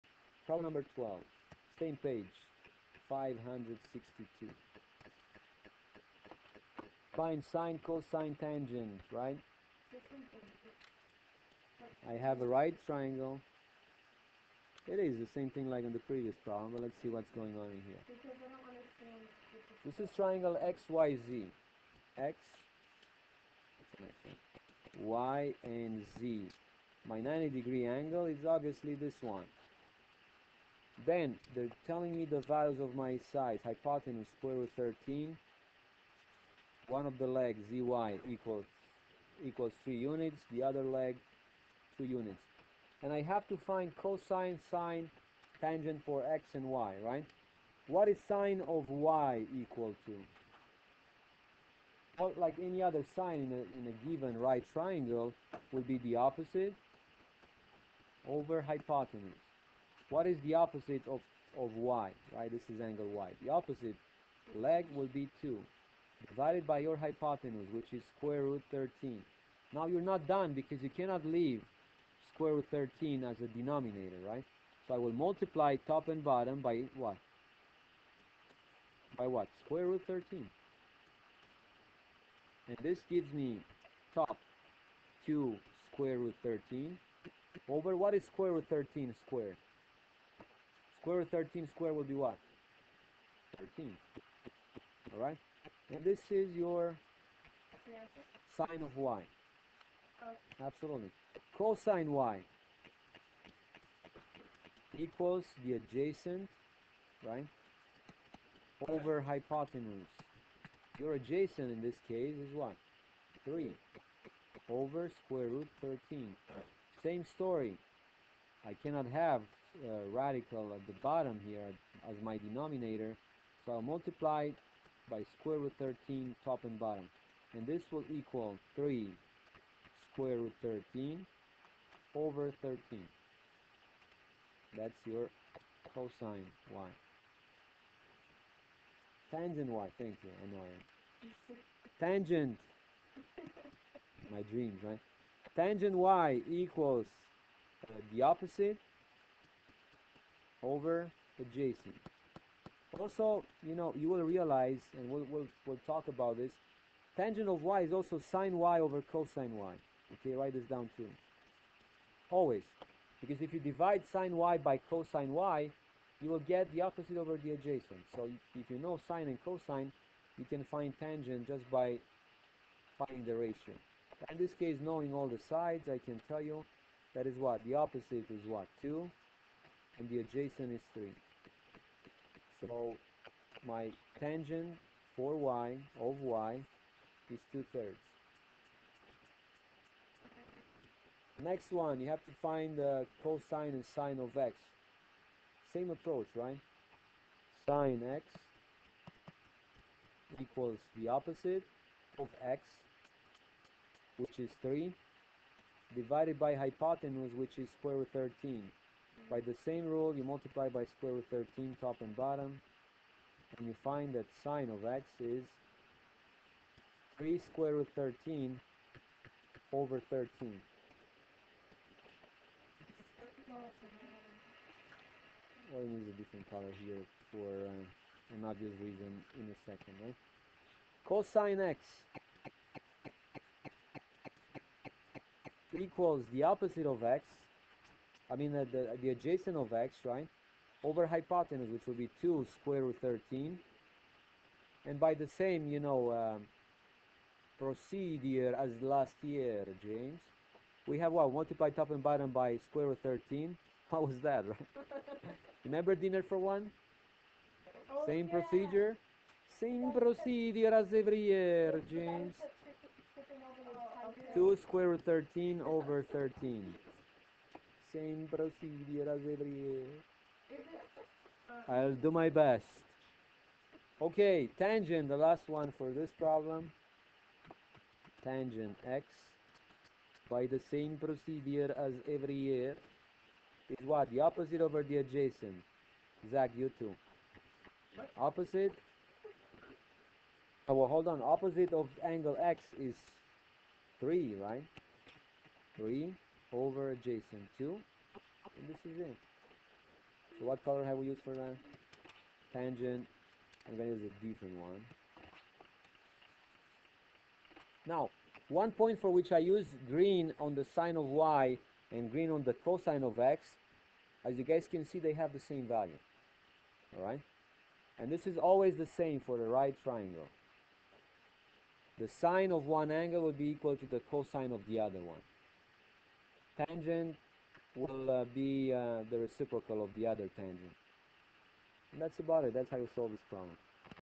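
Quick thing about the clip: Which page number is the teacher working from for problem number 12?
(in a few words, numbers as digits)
562.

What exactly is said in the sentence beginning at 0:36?
One of the legs, zy, equals, equals 3 units.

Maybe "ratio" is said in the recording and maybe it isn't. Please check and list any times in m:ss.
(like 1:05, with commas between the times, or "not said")
2:53.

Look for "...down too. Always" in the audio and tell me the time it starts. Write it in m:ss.
2:40.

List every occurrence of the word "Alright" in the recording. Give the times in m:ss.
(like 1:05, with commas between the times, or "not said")
1:35, 5:16.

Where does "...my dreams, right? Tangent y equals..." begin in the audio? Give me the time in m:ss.
2:24.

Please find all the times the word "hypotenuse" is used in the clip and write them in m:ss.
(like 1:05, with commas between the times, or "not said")
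0:33, 0:58, 1:06, 1:49, 3:26, 4:01.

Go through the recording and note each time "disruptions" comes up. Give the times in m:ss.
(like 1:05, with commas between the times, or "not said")
not said.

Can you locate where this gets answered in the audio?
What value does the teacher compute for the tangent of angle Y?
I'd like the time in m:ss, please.
3:07.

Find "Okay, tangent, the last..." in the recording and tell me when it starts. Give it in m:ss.
4:34.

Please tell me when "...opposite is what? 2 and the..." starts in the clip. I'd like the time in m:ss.
2:57.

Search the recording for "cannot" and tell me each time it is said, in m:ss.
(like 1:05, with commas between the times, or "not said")
1:10, 1:58.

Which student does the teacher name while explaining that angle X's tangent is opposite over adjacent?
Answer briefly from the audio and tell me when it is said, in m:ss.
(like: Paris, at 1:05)
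Zach, at 4:46.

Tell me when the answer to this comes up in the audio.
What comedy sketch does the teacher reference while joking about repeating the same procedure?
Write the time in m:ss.
4:15.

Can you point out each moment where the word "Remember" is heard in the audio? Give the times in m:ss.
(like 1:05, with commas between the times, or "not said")
4:15.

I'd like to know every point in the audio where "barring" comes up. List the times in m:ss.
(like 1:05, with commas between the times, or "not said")
not said.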